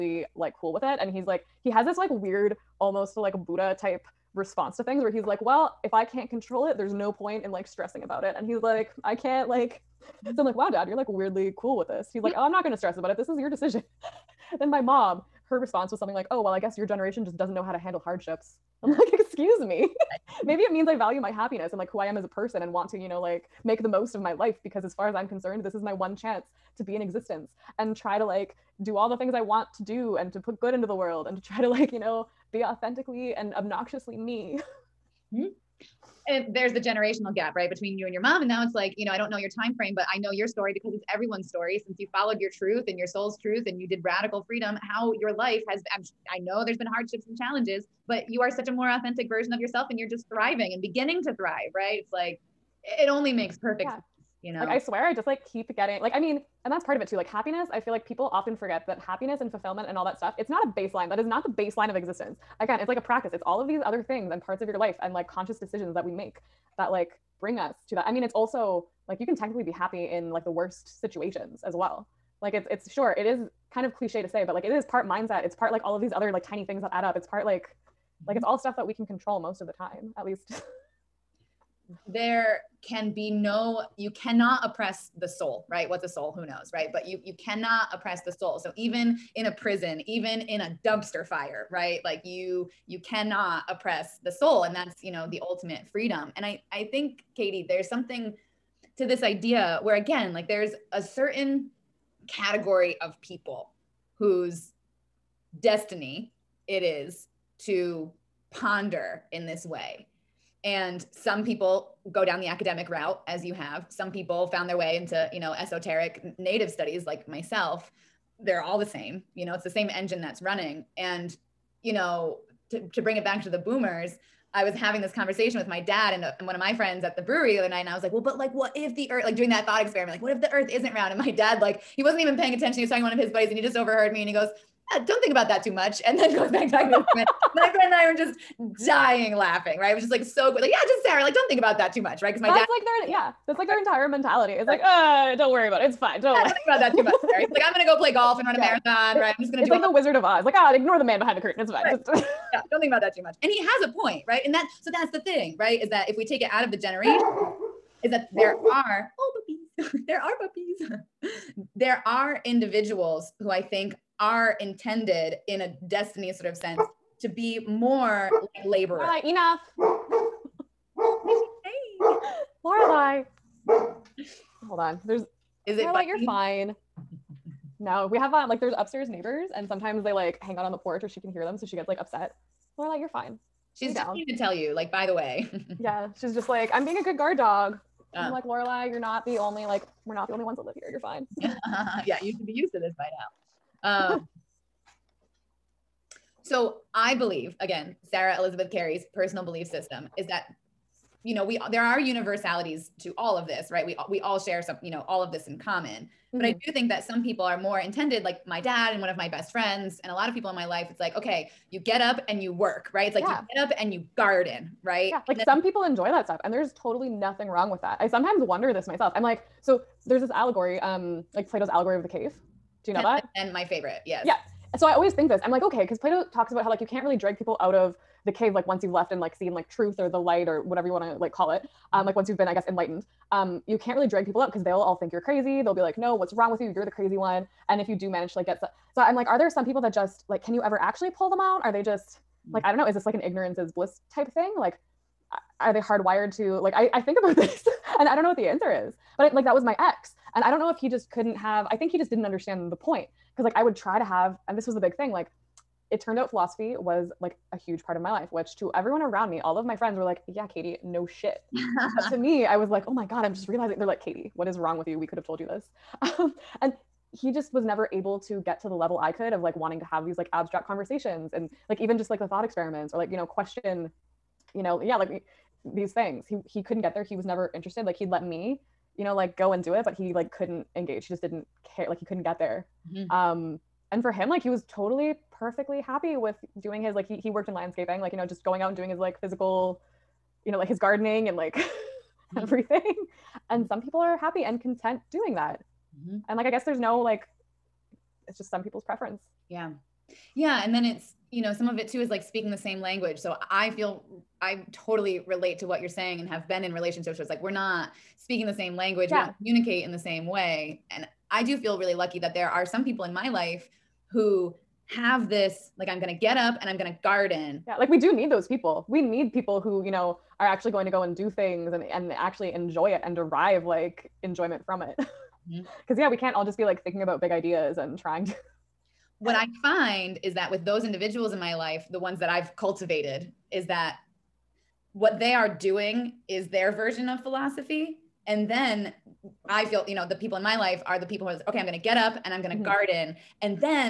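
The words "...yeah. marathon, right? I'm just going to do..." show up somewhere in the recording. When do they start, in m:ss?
2:28.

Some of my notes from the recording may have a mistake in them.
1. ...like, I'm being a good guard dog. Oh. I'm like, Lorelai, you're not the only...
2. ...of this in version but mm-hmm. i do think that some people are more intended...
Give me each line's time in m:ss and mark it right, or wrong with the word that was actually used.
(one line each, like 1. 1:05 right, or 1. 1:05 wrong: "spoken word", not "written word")
1. 3:06 right
2. 3:25 wrong: "common", not "version".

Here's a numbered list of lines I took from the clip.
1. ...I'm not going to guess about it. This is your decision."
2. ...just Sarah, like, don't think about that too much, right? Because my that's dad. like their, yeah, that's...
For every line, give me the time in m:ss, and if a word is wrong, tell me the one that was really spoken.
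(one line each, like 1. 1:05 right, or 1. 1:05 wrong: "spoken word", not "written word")
1. 0:12 wrong: "stress", not "guess"
2. 2:20 right.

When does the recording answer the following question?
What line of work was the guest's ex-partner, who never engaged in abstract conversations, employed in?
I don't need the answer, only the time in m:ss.
4:47.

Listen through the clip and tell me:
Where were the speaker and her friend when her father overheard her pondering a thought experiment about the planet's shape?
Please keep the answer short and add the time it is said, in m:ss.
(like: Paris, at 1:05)
the brewery, at 2:07.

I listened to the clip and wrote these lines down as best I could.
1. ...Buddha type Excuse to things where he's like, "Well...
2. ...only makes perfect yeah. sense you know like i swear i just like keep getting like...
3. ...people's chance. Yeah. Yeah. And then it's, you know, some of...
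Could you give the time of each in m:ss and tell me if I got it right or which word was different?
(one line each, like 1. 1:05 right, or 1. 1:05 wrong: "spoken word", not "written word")
1. 0:03 wrong: "response", not "Excuse"
2. 0:53 right
3. 4:58 wrong: "preference", not "chance".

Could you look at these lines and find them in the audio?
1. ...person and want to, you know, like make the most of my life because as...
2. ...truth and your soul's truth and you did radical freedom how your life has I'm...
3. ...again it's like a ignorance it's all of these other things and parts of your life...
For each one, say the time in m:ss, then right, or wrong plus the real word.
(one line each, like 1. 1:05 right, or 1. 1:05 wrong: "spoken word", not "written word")
1. 0:22 right
2. 0:42 right
3. 1:02 wrong: "practice", not "ignorance".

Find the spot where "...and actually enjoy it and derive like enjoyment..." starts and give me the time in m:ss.
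5:21.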